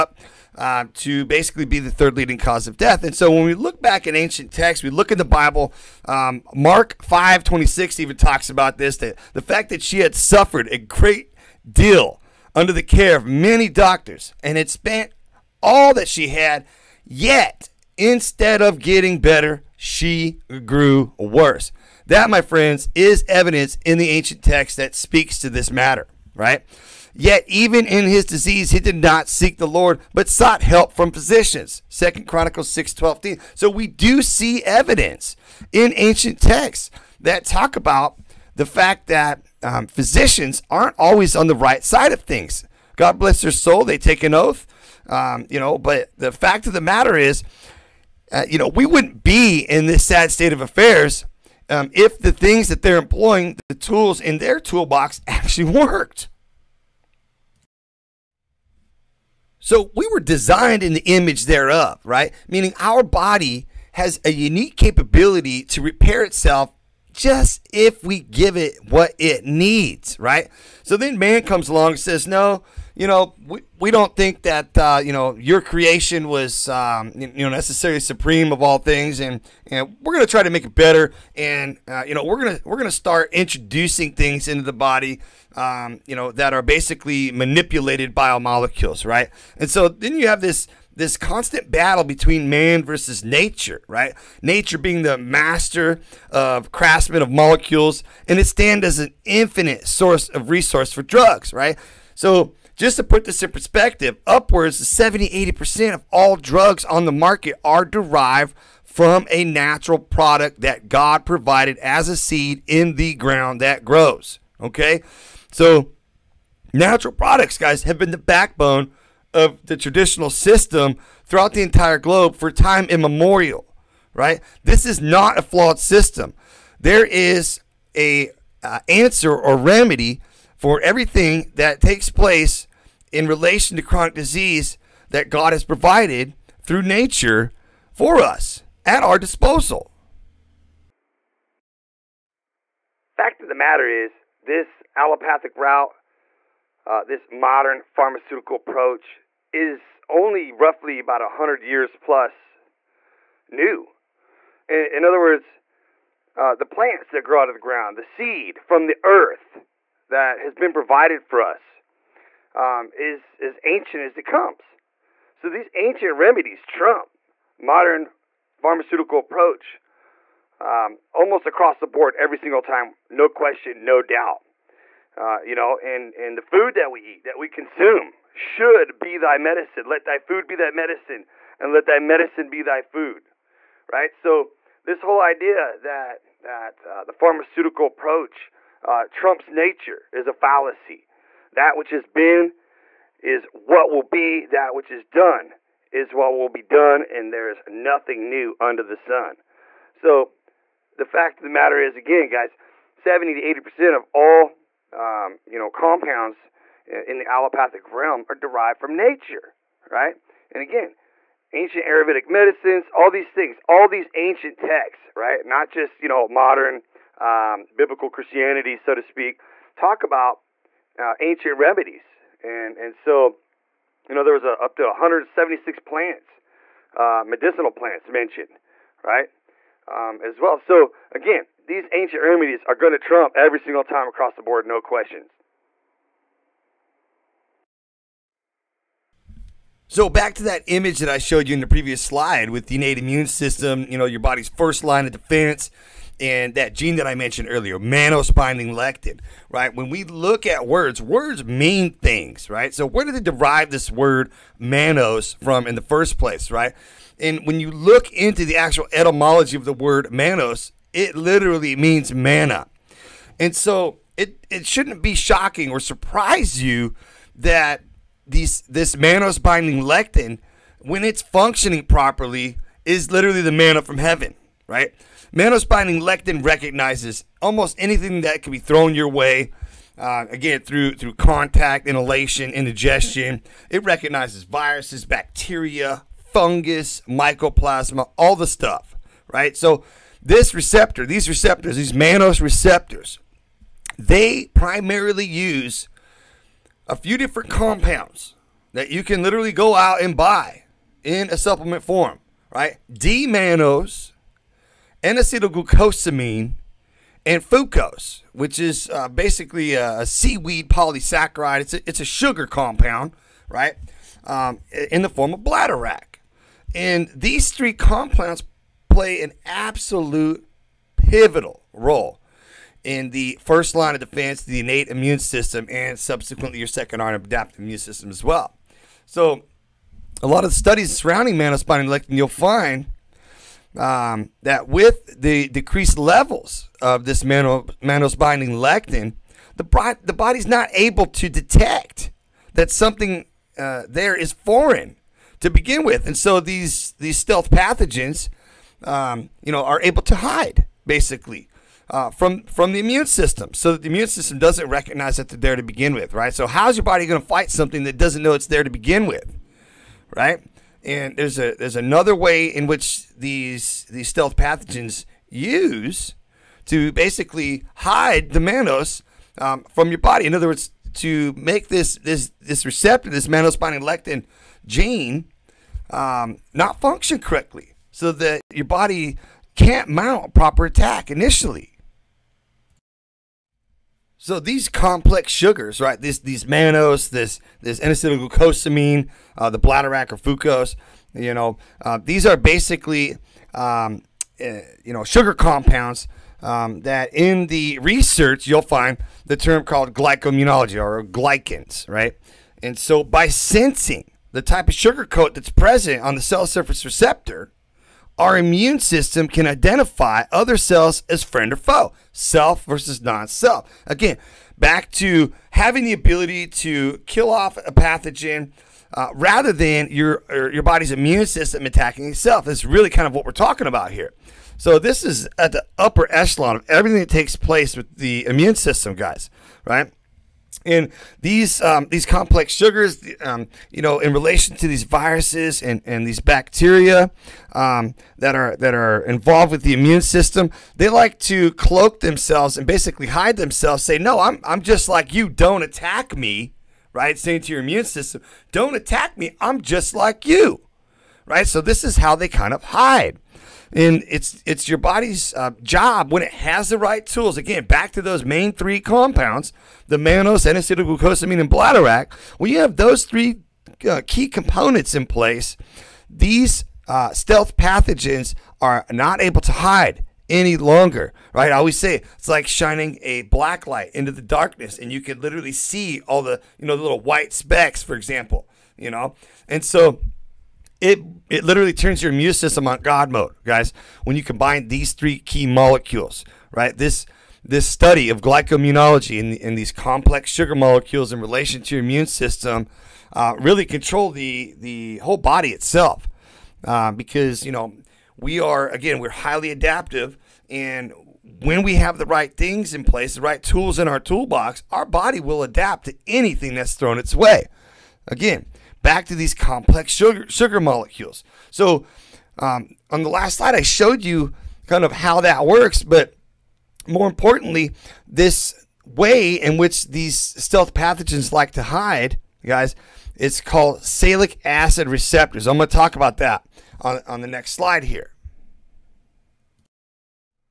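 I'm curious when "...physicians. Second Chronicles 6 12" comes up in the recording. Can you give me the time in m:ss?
0:31.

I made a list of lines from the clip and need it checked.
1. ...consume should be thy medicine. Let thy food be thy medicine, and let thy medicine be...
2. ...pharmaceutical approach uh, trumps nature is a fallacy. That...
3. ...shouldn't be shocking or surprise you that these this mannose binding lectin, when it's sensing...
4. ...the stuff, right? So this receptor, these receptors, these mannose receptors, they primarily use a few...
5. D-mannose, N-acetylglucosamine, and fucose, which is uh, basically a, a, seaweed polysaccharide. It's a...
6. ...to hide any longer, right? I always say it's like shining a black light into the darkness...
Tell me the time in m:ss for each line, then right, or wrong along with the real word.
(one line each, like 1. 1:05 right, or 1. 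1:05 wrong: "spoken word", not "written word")
1. 2:57 right
2. 3:07 right
3. 4:24 wrong: "functioning", not "sensing"
4. 4:48 right
5. 5:02 right
6. 7:49 right.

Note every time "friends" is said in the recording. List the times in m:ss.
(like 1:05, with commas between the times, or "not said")
0:22, 6:51.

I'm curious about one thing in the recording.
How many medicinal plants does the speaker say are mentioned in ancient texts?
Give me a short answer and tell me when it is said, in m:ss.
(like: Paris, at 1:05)
176, at 3:44.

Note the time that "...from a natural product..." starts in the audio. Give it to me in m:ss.
1:48.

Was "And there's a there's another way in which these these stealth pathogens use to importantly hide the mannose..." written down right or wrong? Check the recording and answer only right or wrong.
wrong.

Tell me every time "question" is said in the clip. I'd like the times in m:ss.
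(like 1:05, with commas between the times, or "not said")
2:53, 3:54.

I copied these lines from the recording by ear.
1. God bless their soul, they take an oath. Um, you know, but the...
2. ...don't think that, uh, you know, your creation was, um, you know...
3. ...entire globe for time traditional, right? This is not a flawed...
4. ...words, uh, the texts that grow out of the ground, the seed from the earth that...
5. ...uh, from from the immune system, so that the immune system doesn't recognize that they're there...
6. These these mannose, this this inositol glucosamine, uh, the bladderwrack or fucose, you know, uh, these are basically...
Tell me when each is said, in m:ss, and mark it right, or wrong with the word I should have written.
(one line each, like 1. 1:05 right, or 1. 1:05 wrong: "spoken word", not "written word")
1. 0:42 right
2. 1:13 right
3. 2:01 wrong: "immemorial", not "traditional"
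4. 2:35 wrong: "plants", not "texts"
5. 5:51 right
6. 6:25 right.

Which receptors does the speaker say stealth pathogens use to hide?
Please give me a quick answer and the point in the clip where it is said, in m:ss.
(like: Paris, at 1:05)
sialic acid receptors, at 8:43.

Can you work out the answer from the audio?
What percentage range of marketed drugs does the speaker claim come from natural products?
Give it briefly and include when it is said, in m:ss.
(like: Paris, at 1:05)
70-80%, at 1:44.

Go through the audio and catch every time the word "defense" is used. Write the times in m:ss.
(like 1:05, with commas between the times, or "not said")
4:05, 5:23.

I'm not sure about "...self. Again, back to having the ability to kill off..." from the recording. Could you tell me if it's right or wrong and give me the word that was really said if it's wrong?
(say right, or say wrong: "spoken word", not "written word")
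right.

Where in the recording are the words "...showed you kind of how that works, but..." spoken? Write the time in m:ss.
8:33.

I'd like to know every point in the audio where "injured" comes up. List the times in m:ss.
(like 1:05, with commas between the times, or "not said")
not said.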